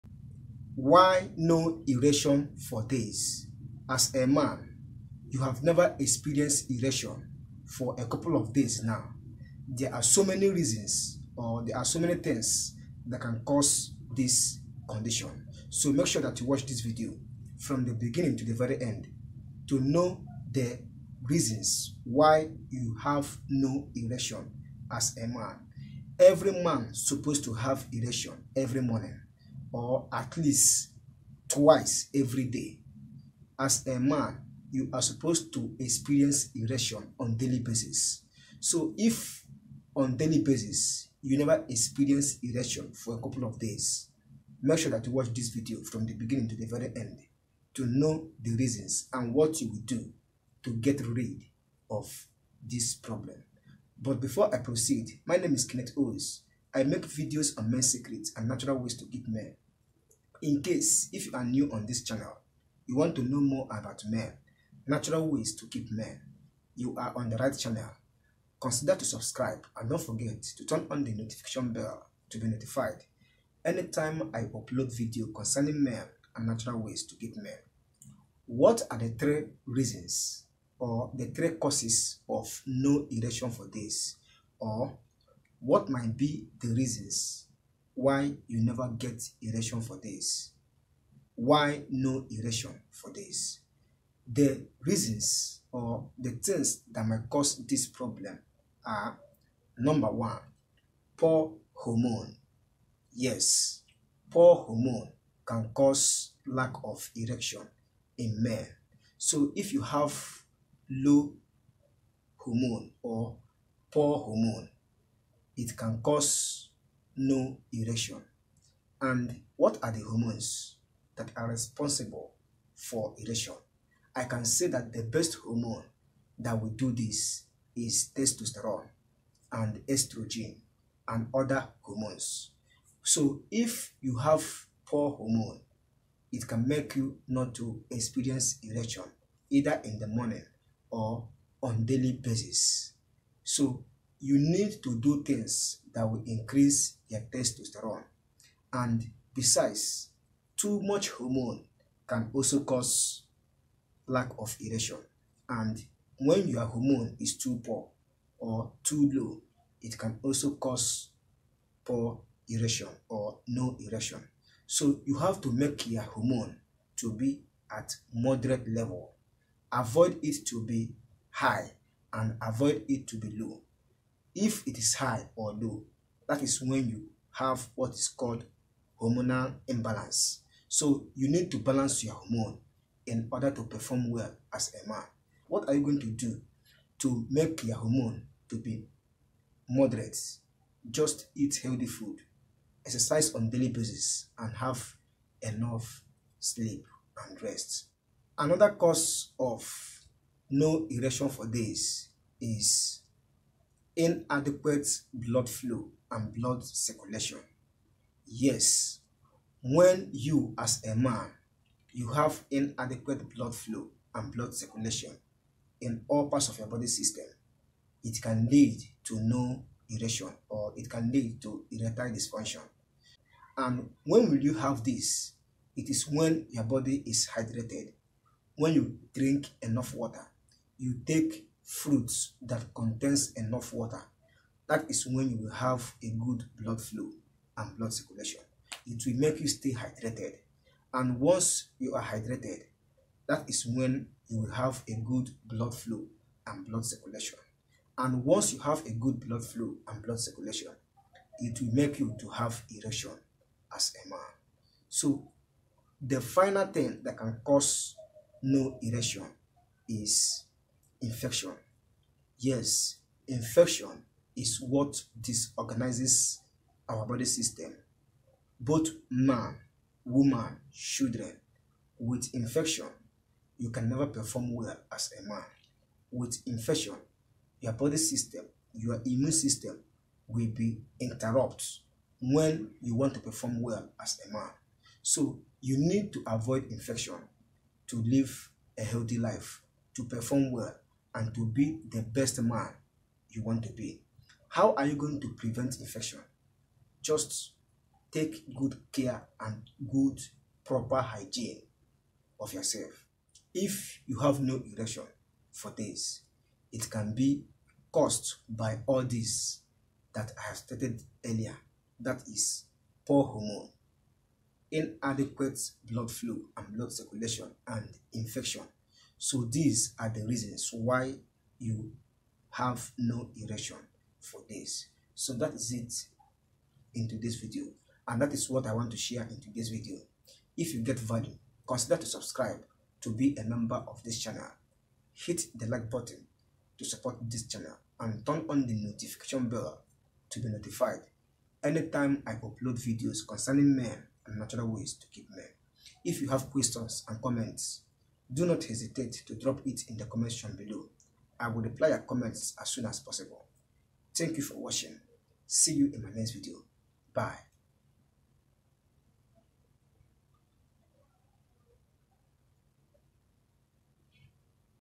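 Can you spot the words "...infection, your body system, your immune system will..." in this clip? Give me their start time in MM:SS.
04:36.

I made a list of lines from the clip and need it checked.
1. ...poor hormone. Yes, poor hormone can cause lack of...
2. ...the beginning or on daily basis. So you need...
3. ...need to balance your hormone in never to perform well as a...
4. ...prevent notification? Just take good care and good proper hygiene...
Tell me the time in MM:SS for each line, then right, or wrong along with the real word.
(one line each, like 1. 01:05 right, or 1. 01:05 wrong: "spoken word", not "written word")
1. 01:41 right
2. 02:19 wrong: "morning", not "beginning"
3. 03:01 wrong: "order", not "never"
4. 04:55 wrong: "infection", not "notification".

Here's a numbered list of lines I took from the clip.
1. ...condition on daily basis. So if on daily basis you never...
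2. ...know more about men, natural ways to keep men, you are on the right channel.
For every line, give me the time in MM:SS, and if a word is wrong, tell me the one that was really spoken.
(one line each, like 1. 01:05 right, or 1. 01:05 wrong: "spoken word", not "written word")
1. 00:36 wrong: "erection", not "condition"
2. 01:03 right.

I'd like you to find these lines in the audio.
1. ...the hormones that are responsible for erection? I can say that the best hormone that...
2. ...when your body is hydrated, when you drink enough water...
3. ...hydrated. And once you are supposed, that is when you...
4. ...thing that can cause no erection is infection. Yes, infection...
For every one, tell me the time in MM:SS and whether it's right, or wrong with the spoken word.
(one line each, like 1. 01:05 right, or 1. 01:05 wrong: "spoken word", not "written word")
1. 01:59 right
2. 03:46 right
3. 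03:59 wrong: "hydrated", not "supposed"
4. 04:16 right.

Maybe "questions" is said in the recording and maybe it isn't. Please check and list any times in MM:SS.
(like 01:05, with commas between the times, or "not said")
05:46.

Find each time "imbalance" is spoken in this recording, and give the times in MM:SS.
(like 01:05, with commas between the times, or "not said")
02:59.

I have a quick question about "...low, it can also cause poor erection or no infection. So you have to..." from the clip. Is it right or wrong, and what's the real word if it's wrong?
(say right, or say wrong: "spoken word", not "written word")
wrong: "erection", not "infection".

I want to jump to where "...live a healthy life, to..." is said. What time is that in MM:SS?
04:48.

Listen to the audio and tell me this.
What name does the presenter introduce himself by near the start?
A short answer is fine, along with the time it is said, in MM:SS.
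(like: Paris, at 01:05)
Kenneth Owens, at 00:55.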